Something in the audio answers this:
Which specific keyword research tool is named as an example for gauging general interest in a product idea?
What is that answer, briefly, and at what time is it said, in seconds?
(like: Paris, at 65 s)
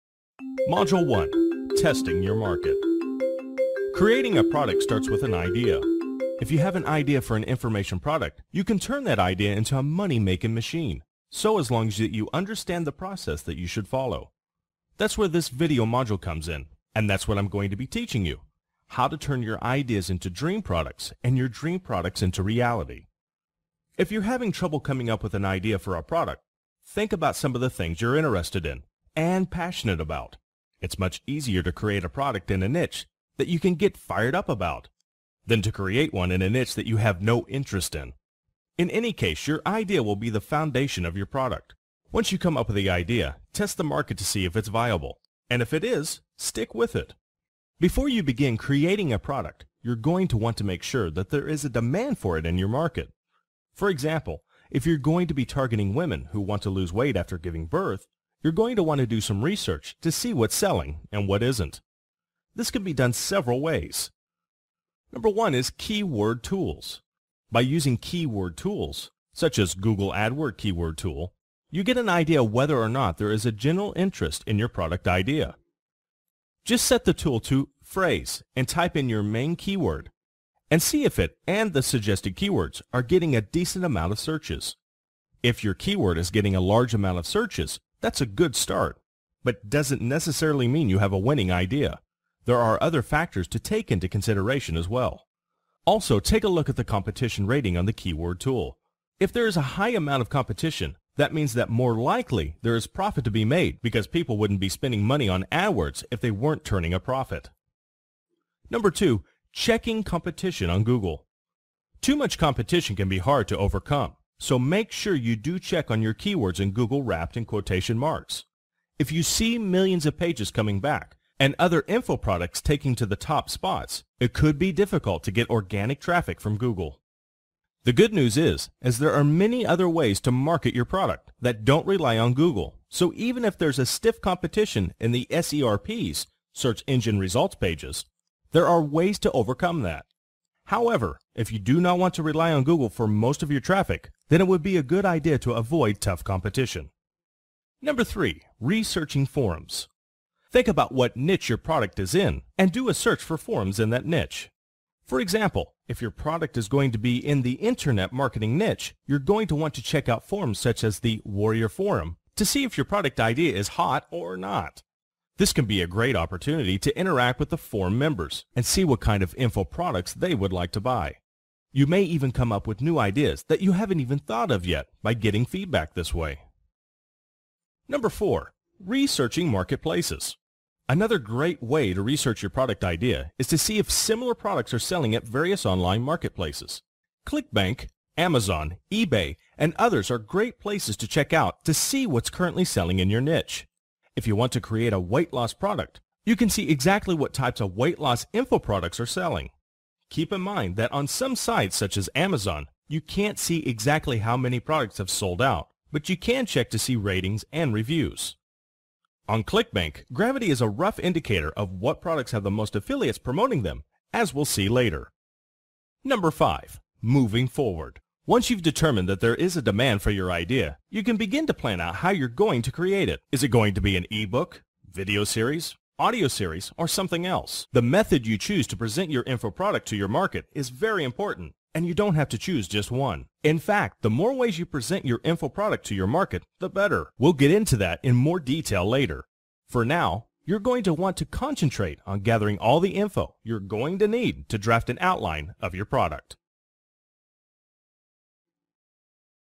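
Google AdWord Keyword Tool, at 69 s.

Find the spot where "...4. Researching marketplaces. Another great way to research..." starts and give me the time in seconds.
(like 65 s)
178 s.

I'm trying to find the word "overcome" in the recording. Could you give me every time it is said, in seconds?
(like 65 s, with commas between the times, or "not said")
113 s, 139 s.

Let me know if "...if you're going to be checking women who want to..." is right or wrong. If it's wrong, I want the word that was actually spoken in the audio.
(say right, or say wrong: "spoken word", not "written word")
wrong: "targeting", not "checking".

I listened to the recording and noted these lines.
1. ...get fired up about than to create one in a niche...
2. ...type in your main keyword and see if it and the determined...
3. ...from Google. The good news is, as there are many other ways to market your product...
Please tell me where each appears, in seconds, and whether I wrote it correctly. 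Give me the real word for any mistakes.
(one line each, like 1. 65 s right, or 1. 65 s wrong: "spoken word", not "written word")
1. 33 s right
2. 78 s wrong: "suggested", not "determined"
3. 126 s right.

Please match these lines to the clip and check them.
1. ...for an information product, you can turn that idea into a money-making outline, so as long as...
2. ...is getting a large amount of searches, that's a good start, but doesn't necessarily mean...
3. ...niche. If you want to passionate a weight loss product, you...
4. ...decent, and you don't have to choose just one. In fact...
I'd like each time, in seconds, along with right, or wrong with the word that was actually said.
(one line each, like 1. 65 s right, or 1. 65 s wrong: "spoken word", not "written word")
1. 7 s wrong: "machine", not "outline"
2. 86 s right
3. 193 s wrong: "create", not "passionate"
4. 231 s wrong: "important", not "decent".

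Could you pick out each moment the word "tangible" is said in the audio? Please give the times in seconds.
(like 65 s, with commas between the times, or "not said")
not said.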